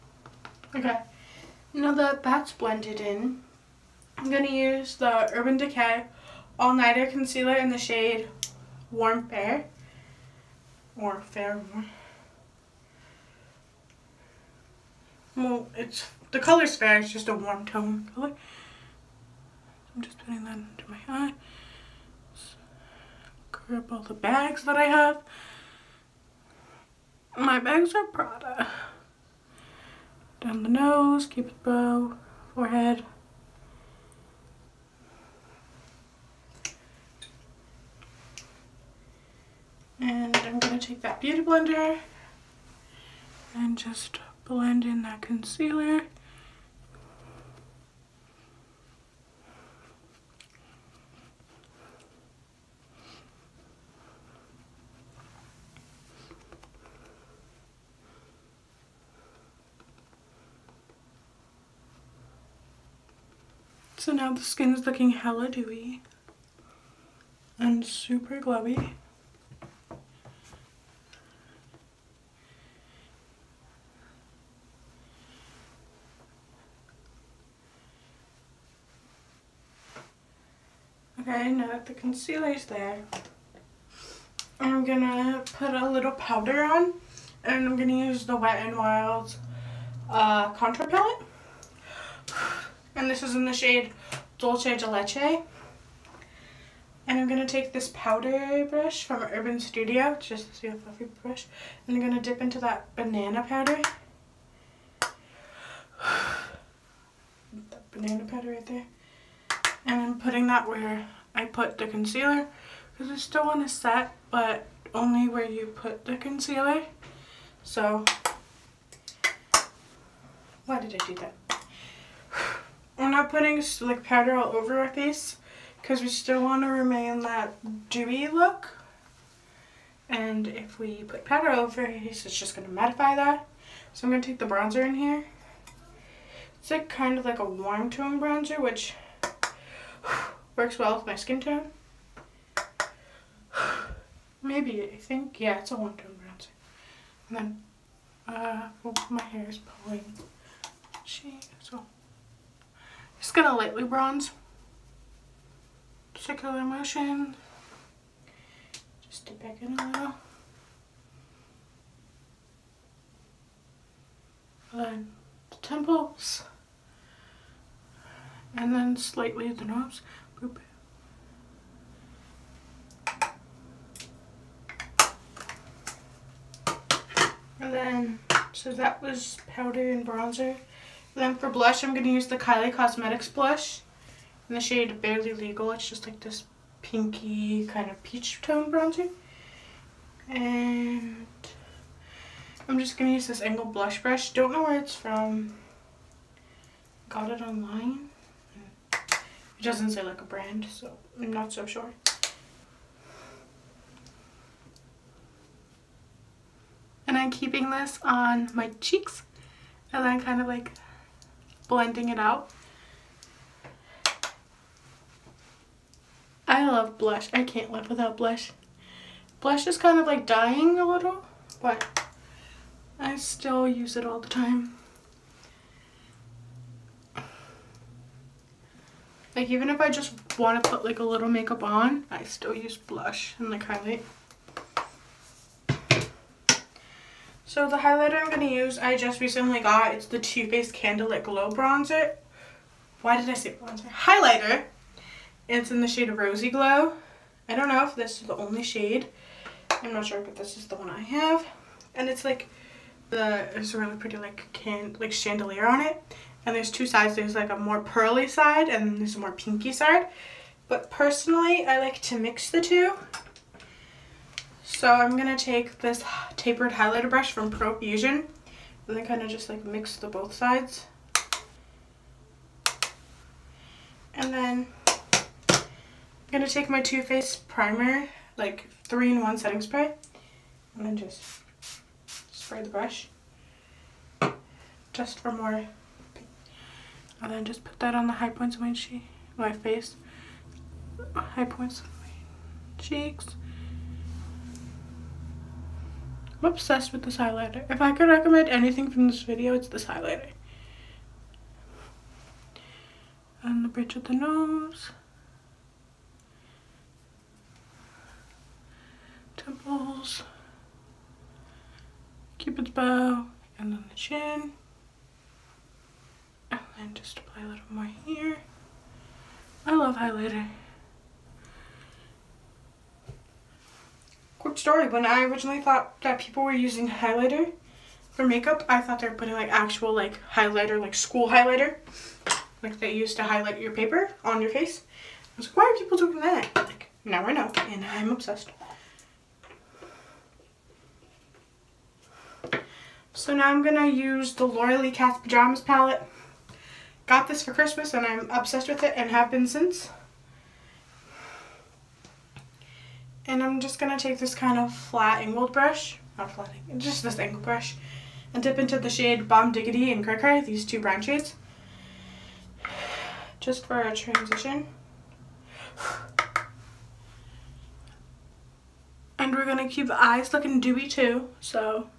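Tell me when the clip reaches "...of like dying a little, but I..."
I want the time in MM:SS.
03:39.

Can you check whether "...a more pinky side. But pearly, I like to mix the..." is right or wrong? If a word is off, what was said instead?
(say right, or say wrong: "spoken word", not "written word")
wrong: "personally", not "pearly".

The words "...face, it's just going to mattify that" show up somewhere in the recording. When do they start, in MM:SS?
02:11.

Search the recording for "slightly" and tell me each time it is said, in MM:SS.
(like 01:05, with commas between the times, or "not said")
02:48.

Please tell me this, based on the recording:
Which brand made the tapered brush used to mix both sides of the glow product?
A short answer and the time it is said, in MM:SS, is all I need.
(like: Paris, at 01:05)
Profusion, at 04:27.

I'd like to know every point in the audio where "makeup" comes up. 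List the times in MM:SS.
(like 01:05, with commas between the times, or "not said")
03:51, 05:28.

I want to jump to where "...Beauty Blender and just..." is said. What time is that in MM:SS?
00:41.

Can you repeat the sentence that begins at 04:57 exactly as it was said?
If I could recommend anything from this video, it's this highlighter.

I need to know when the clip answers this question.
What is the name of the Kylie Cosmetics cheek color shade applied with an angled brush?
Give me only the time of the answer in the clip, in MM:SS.
03:04.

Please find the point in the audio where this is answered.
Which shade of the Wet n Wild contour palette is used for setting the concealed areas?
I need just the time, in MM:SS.
01:34.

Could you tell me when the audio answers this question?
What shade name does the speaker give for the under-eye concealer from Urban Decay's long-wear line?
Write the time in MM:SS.
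00:08.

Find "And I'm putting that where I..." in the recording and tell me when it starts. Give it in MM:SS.
01:49.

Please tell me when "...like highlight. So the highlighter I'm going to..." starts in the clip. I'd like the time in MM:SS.
03:53.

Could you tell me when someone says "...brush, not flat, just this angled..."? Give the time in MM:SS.
05:55.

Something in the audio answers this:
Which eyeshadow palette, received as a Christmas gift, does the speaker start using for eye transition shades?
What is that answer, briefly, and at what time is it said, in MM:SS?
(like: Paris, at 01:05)
Laura Lee Pajamas palette, at 05:44.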